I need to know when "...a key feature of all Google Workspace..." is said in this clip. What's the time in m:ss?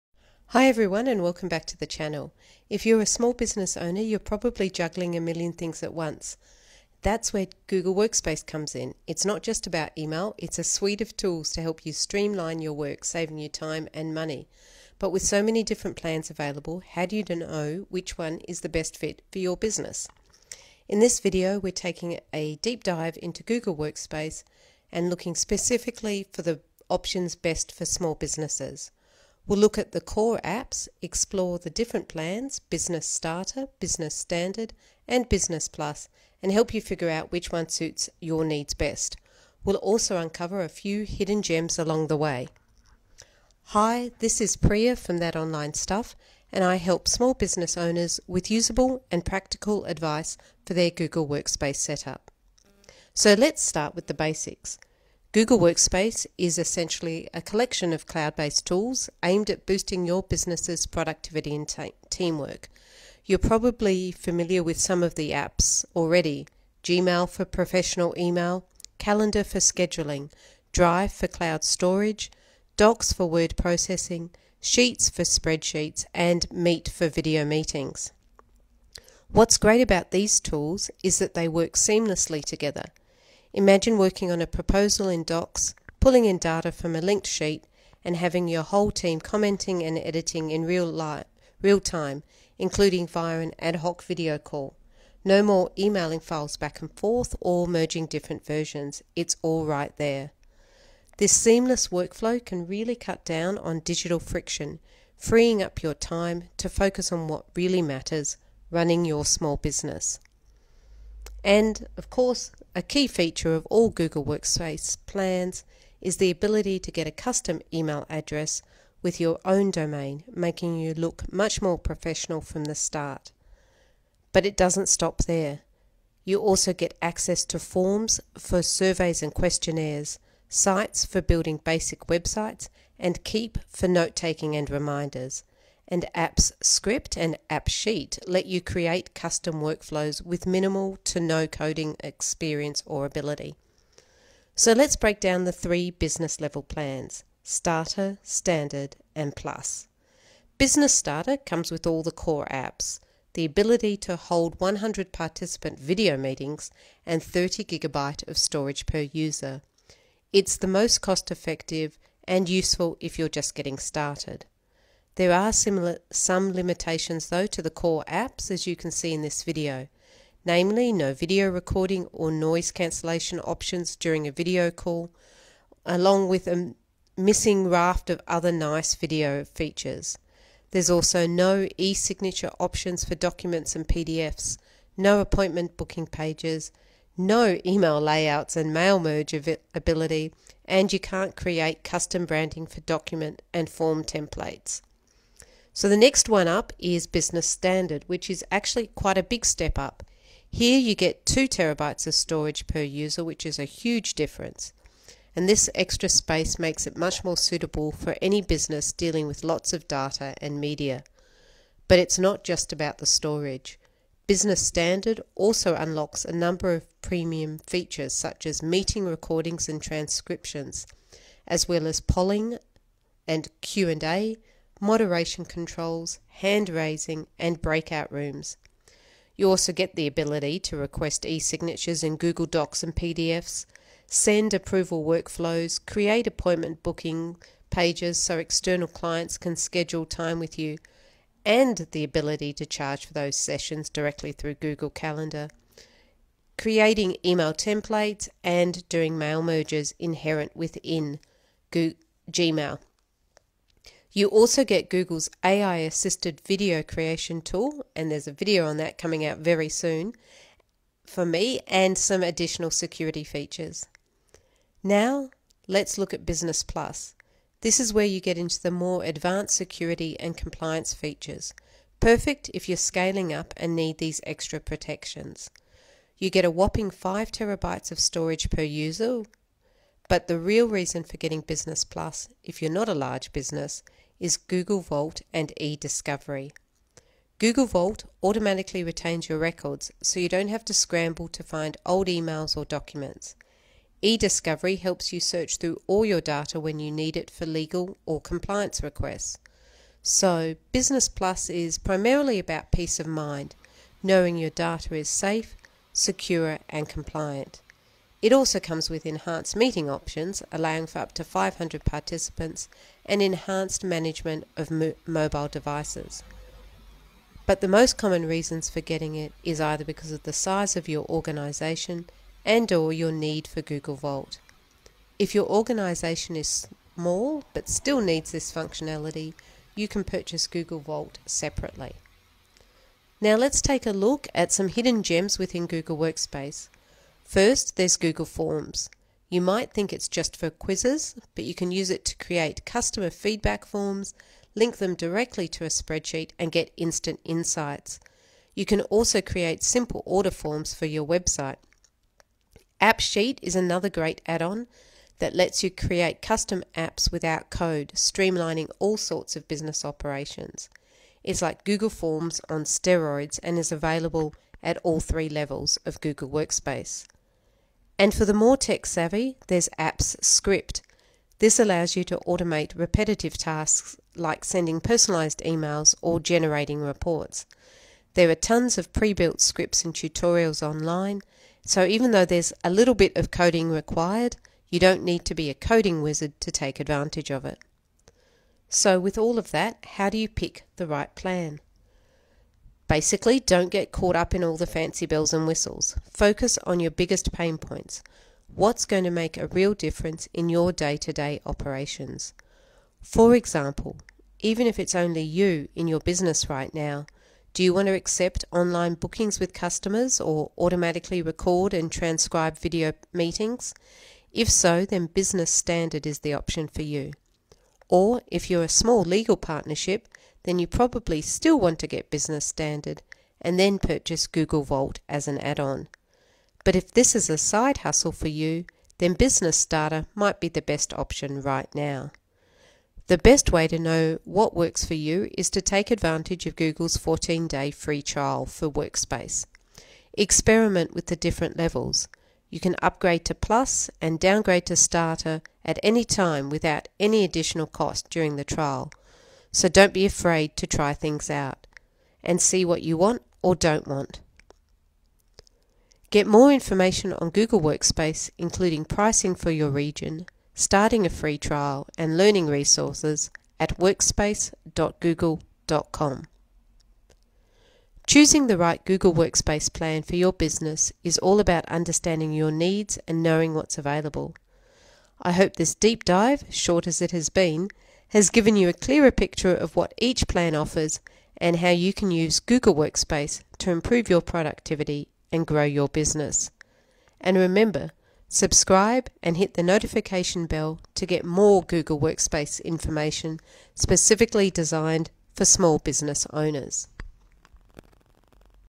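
1:52.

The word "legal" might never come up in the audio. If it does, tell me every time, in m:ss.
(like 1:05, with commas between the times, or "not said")
4:57, 6:59.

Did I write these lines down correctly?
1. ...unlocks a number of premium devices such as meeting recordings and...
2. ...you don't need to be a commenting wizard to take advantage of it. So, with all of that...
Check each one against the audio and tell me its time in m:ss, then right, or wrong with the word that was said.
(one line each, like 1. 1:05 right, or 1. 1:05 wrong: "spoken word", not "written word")
1. 3:35 wrong: "features", not "devices"
2. 6:24 wrong: "coding", not "commenting".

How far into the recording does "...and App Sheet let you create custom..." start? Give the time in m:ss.
2:17.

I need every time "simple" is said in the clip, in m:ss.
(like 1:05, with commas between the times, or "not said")
5:49.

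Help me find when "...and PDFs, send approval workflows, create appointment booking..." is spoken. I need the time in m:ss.
3:52.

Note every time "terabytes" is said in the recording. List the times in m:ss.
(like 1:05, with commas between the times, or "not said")
3:21, 4:37.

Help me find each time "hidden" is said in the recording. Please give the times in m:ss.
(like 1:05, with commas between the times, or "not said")
0:41, 5:34.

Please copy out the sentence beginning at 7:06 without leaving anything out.
But if this is a side hustle for you, then Business Starter might be the best option right now.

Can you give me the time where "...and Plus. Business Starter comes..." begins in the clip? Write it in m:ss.
2:29.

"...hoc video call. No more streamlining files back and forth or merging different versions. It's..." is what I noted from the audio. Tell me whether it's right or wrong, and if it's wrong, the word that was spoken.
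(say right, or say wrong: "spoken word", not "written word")
wrong: "emailing", not "streamlining".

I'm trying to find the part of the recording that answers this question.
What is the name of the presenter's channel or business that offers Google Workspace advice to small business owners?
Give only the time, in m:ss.
0:45.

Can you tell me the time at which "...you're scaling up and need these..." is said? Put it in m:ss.
4:32.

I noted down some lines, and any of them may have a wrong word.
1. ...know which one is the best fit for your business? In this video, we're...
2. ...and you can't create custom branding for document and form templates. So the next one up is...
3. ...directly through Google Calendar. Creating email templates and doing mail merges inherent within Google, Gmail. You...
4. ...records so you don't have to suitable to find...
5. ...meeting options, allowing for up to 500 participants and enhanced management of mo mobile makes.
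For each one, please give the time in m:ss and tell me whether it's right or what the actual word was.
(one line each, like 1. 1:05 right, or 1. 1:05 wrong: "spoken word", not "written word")
1. 0:17 right
2. 3:10 right
3. 4:03 right
4. 4:49 wrong: "scramble", not "suitable"
5. 5:09 wrong: "devices", not "makes".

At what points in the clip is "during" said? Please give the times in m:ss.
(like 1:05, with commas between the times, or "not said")
2:53, 7:28.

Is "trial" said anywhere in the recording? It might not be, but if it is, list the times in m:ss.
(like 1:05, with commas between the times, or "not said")
7:18, 7:28, 7:41.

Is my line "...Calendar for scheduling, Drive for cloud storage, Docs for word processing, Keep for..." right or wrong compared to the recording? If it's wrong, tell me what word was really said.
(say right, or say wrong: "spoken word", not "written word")
wrong: "Sheets", not "Keep".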